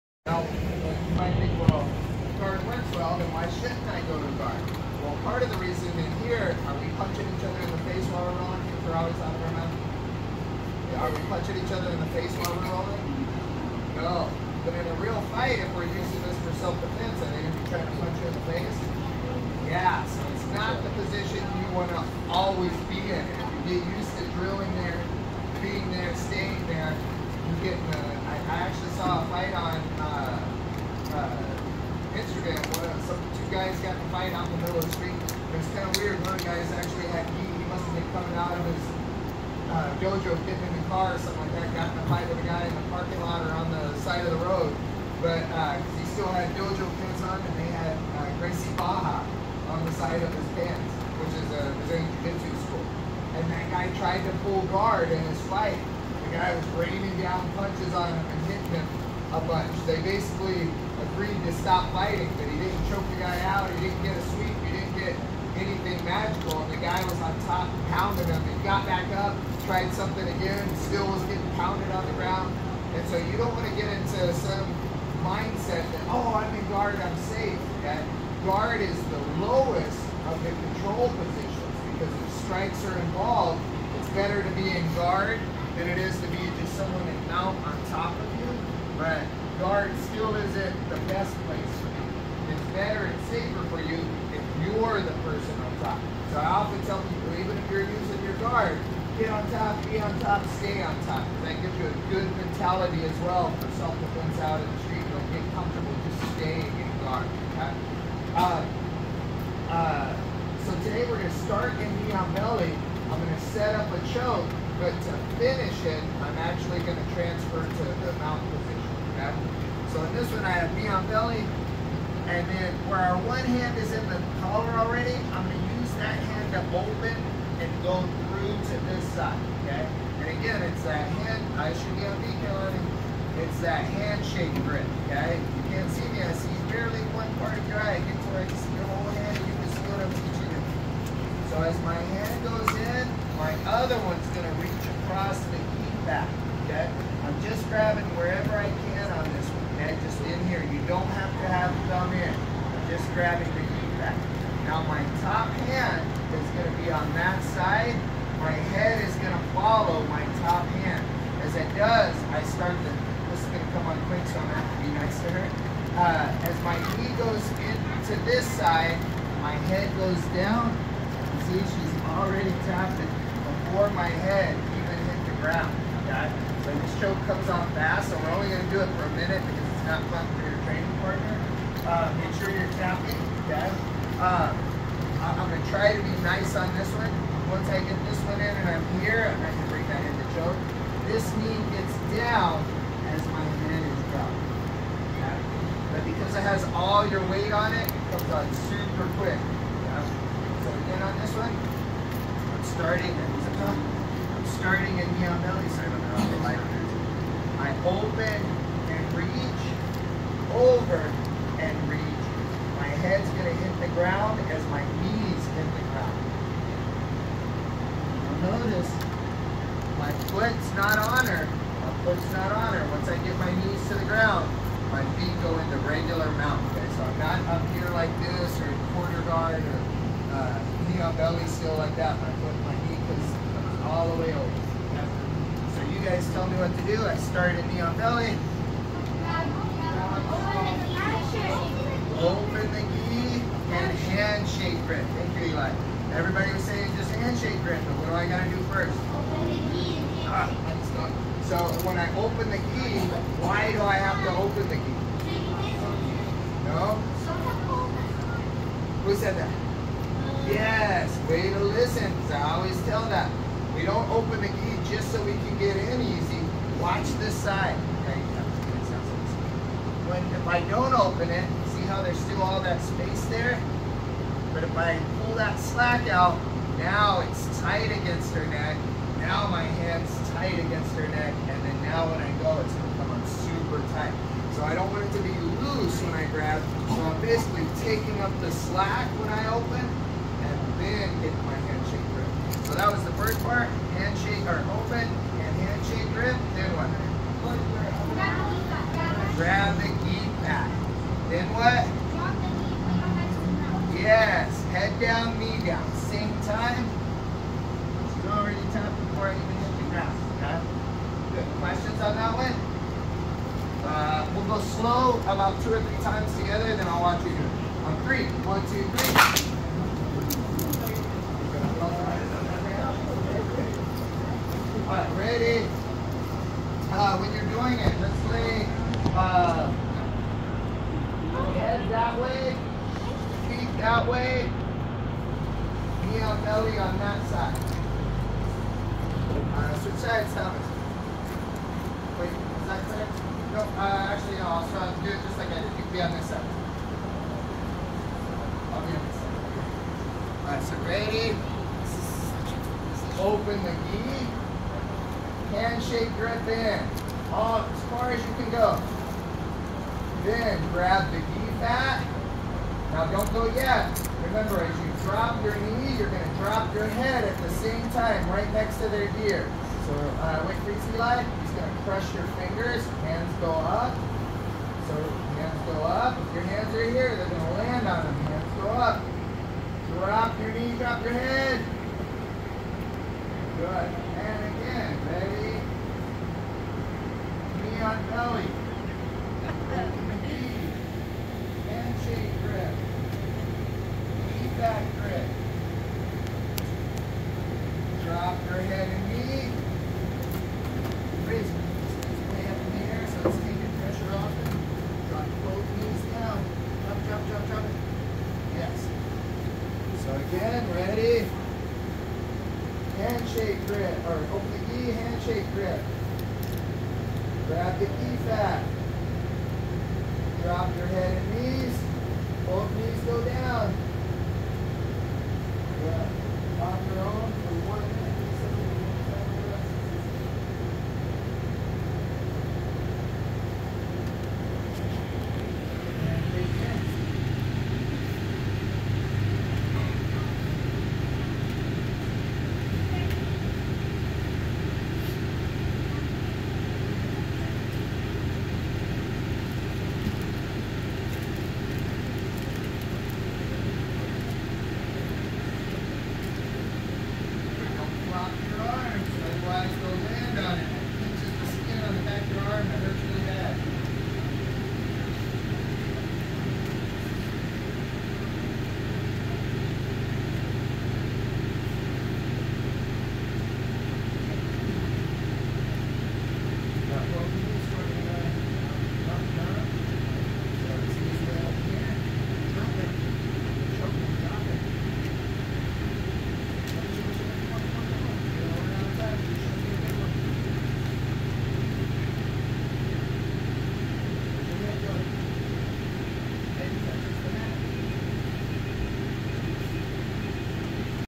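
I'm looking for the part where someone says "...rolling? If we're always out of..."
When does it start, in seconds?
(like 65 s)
8 s.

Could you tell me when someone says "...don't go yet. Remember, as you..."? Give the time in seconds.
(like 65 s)
363 s.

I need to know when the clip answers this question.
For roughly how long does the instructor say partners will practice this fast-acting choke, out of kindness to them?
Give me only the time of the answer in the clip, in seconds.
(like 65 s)
179 s.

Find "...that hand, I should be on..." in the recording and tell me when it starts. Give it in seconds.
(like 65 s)
130 s.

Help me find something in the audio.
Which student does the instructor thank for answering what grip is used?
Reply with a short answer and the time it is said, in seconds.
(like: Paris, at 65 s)
Eli, at 245 s.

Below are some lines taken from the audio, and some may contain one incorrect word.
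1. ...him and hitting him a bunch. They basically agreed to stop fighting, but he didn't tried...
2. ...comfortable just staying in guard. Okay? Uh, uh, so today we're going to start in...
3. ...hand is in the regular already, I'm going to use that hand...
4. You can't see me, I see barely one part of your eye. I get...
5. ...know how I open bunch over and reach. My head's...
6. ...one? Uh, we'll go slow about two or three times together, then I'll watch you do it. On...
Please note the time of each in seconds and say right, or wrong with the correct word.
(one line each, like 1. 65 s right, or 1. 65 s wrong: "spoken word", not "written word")
1. 58 s wrong: "pounded", not "tried"
2. 105 s right
3. 123 s wrong: "collar", not "regular"
4. 135 s right
5. 205 s wrong: "reach", not "bunch"
6. 312 s right.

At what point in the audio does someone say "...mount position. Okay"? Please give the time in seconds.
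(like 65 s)
118 s.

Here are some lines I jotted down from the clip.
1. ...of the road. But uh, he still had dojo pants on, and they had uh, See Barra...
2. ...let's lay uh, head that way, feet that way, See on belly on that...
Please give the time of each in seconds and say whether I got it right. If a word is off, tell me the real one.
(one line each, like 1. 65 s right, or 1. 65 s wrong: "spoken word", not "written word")
1. 44 s wrong: "Gracie", not "See"
2. 328 s wrong: "Knee", not "See".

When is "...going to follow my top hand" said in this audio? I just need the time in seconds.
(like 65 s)
159 s.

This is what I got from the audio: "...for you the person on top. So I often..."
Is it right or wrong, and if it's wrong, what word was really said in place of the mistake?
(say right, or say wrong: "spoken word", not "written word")
right.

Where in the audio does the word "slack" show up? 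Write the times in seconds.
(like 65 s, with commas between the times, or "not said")
275 s, 288 s.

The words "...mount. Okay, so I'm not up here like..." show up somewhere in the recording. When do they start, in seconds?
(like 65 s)
226 s.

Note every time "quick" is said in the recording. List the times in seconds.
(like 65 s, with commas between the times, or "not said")
164 s, 199 s.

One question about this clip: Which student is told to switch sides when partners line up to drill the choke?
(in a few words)
Thomas.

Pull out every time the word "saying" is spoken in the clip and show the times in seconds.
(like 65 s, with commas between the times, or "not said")
246 s.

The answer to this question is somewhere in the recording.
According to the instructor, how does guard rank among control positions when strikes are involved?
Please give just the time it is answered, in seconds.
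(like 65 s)
79 s.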